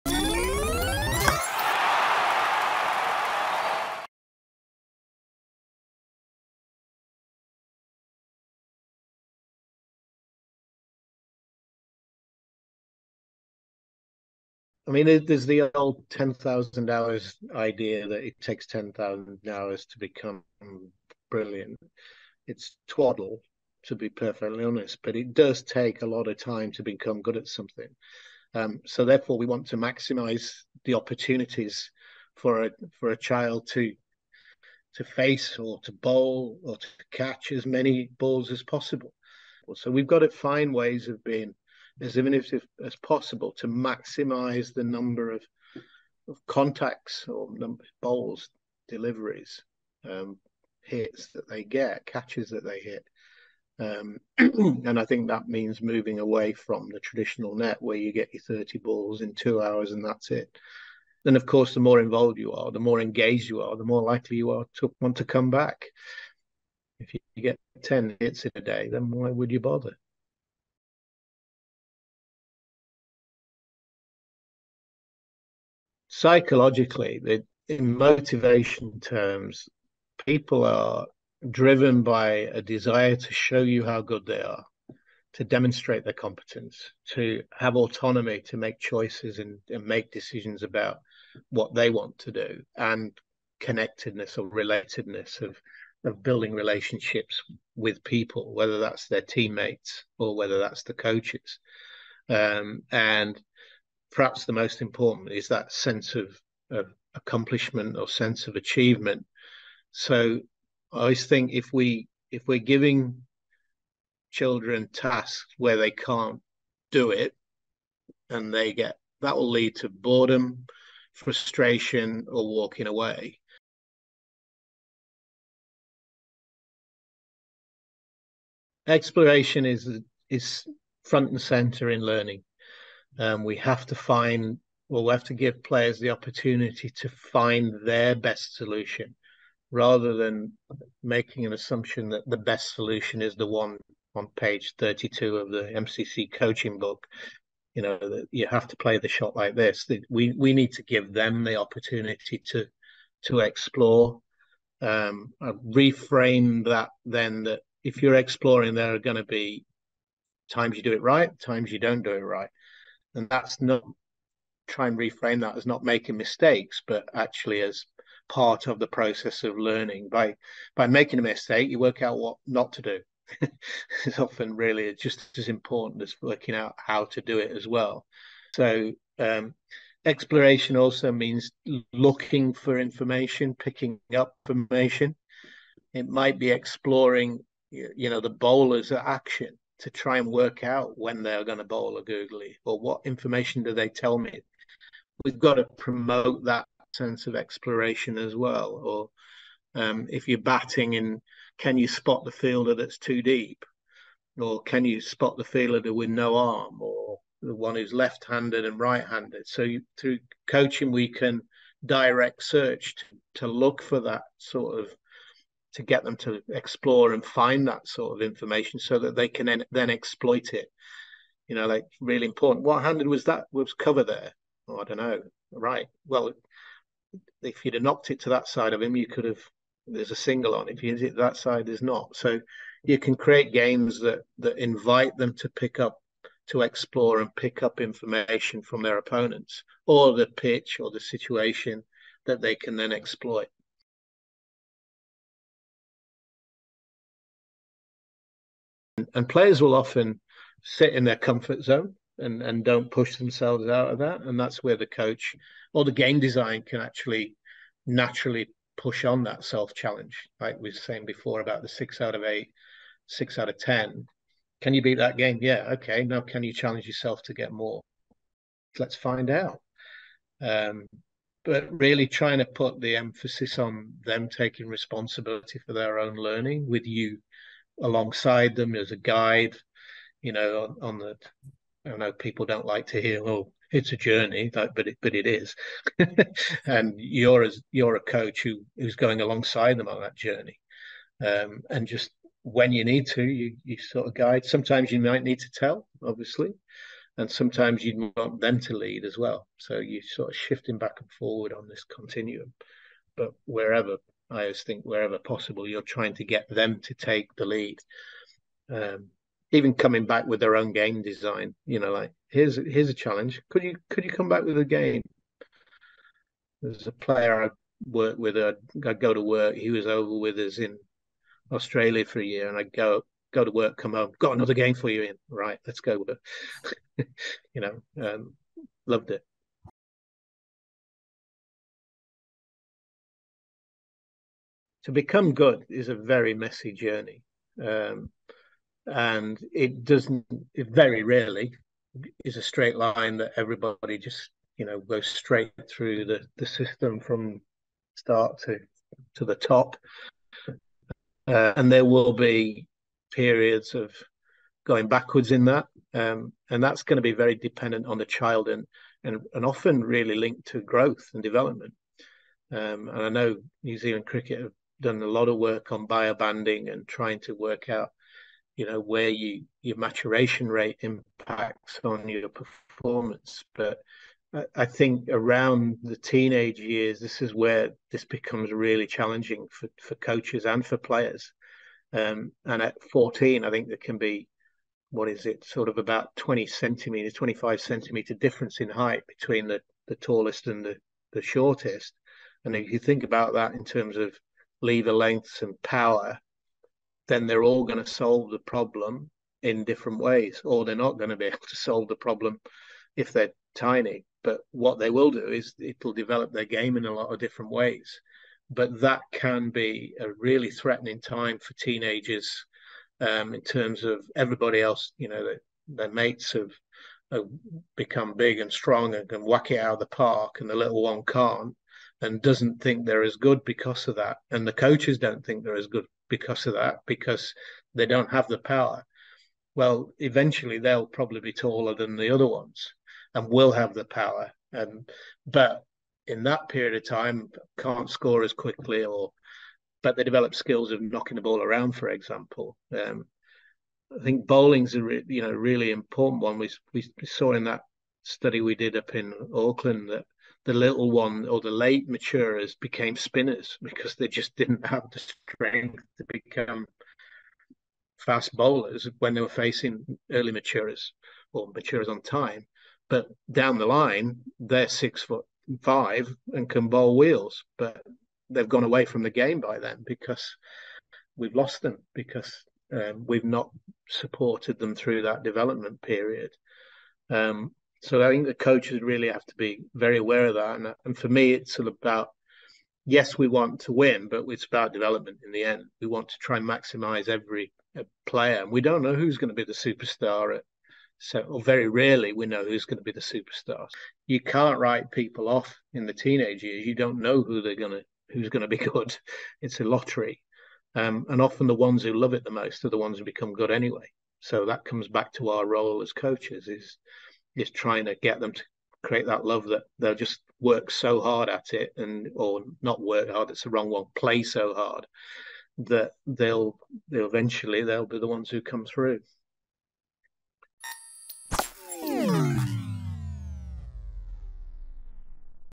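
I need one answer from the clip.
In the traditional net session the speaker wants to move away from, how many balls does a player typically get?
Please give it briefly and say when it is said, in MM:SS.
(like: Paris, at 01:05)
30, at 00:58.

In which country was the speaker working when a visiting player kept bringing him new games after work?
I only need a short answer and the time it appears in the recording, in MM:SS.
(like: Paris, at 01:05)
Australia, at 05:21.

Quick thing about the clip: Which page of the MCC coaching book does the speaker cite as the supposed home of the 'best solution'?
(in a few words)
32.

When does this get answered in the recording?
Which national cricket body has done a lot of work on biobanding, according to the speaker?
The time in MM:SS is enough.
06:03.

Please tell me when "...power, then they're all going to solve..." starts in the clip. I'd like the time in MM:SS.
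06:35.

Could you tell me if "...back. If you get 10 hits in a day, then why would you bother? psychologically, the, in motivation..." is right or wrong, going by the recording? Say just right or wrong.
right.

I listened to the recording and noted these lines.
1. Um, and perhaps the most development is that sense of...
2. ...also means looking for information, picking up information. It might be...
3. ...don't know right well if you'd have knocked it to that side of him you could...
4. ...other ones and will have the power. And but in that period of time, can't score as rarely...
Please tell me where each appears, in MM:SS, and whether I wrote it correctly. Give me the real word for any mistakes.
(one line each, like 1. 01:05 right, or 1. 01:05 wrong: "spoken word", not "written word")
1. 01:42 wrong: "important", not "development"
2. 03:00 right
3. 03:44 right
4. 07:12 wrong: "quickly", not "rarely".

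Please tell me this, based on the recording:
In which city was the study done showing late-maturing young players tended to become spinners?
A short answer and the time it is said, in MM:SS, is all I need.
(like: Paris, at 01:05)
Auckland, at 07:29.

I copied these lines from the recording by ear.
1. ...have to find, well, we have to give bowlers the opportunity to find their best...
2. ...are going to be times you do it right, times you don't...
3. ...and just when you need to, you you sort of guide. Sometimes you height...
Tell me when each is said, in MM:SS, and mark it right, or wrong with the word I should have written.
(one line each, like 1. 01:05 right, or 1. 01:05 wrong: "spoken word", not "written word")
1. 02:13 wrong: "players", not "bowlers"
2. 02:38 right
3. 04:51 wrong: "might", not "height".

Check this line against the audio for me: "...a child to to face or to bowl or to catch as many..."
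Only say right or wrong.
right.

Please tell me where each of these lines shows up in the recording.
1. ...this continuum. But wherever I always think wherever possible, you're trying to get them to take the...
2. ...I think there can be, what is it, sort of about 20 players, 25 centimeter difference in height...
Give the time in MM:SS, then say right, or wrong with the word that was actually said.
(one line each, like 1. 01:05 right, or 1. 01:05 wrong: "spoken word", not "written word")
1. 05:01 right
2. 06:23 wrong: "centimeters", not "players".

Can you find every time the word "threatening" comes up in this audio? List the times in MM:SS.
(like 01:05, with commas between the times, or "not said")
06:50.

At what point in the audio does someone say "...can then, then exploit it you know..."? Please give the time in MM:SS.
03:39.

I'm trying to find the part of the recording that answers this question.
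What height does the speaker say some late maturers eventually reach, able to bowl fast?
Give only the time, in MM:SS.
07:44.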